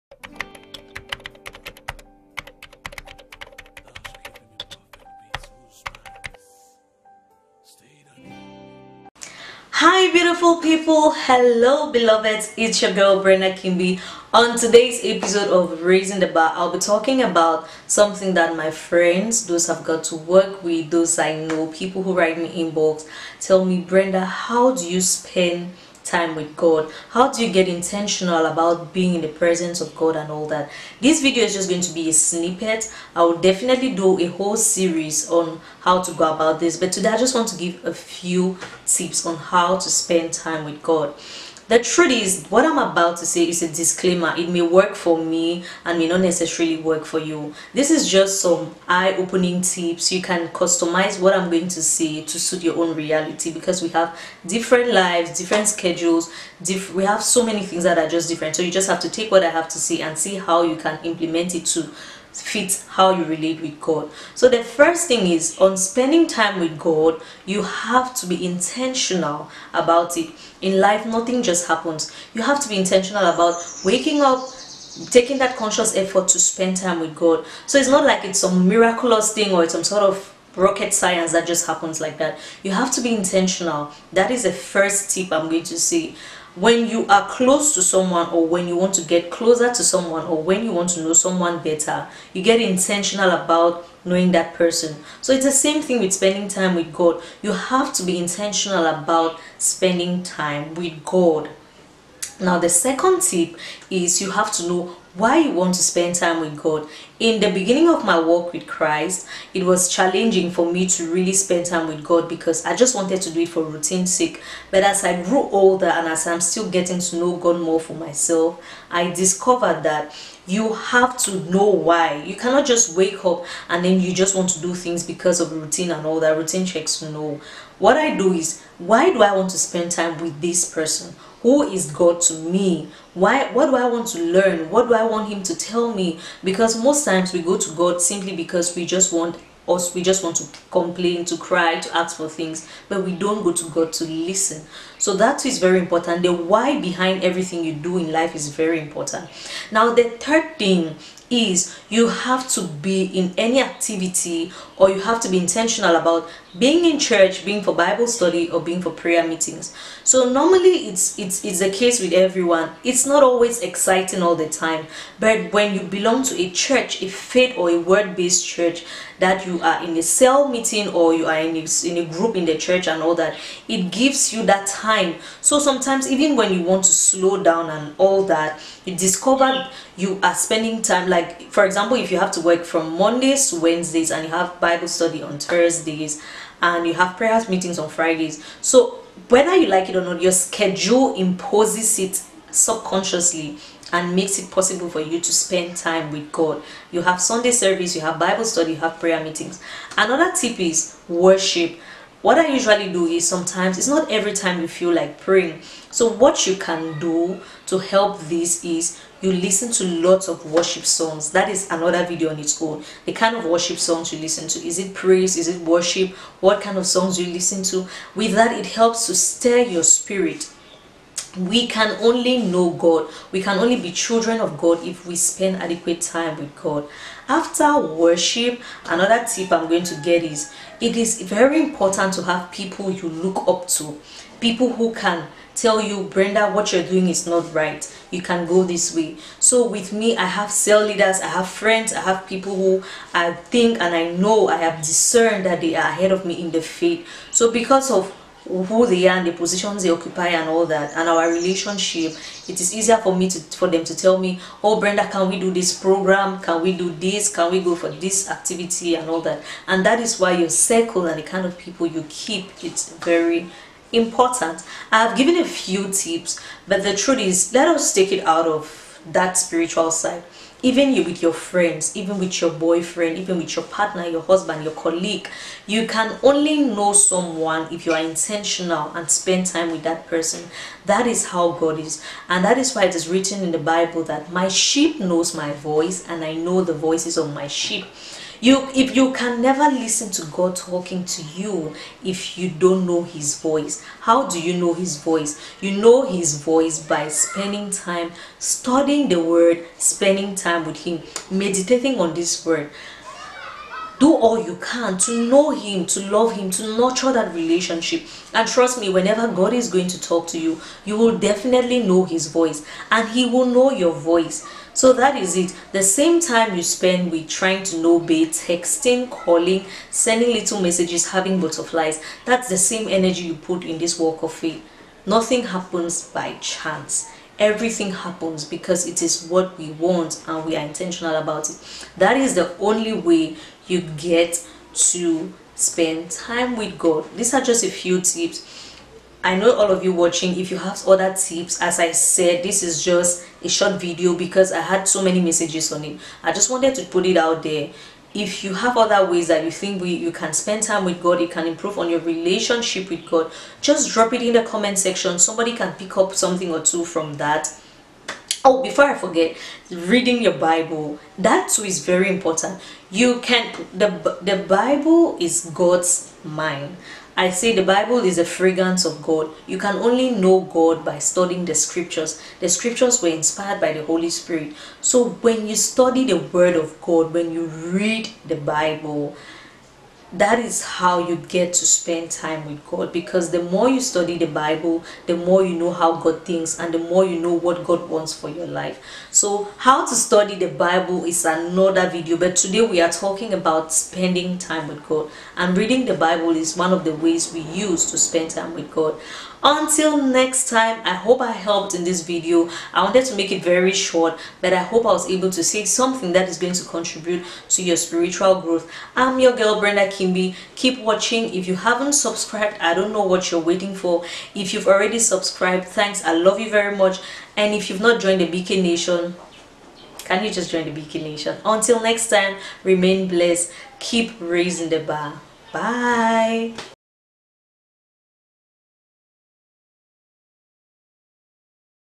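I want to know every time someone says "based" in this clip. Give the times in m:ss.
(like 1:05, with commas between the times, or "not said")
2:47.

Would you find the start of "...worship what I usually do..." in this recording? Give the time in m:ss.
3:21.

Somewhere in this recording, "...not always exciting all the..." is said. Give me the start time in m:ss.
2:43.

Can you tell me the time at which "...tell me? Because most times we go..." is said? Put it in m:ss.
2:15.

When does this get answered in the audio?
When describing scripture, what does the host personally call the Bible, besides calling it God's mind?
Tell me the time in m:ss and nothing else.
6:08.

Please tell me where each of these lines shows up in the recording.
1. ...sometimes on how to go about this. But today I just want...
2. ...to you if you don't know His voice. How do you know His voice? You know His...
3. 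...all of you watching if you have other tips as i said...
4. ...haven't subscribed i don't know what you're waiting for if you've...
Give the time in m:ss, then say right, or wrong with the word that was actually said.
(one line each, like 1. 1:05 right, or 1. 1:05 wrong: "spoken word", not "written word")
1. 0:34 wrong: "series", not "sometimes"
2. 4:51 right
3. 5:39 right
4. 6:51 right.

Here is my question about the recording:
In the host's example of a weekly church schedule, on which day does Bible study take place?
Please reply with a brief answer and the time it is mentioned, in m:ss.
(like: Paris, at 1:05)
Thursdays, at 3:05.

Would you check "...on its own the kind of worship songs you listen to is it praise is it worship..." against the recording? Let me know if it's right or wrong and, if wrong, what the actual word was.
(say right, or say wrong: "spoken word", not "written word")
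right.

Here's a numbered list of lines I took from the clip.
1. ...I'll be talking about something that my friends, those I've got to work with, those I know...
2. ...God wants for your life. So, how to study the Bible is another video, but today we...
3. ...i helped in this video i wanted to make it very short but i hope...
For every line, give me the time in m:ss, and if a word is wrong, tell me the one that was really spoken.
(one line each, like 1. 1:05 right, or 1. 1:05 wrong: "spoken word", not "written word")
1. 0:16 right
2. 6:27 right
3. 6:41 right.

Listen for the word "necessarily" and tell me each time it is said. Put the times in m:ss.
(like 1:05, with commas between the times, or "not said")
0:46.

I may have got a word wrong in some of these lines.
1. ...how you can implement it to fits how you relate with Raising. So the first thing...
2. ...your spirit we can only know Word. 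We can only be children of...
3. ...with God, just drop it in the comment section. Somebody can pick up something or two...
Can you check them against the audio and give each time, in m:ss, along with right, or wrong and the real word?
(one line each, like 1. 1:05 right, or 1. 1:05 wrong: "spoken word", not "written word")
1. 1:00 wrong: "God", not "Raising"
2. 3:39 wrong: "God", not "Word"
3. 5:52 right.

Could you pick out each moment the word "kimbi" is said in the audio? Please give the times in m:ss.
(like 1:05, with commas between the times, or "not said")
0:13, 6:49.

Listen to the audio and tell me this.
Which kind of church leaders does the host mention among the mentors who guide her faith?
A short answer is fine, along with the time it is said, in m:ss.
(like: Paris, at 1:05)
cell leaders, at 4:00.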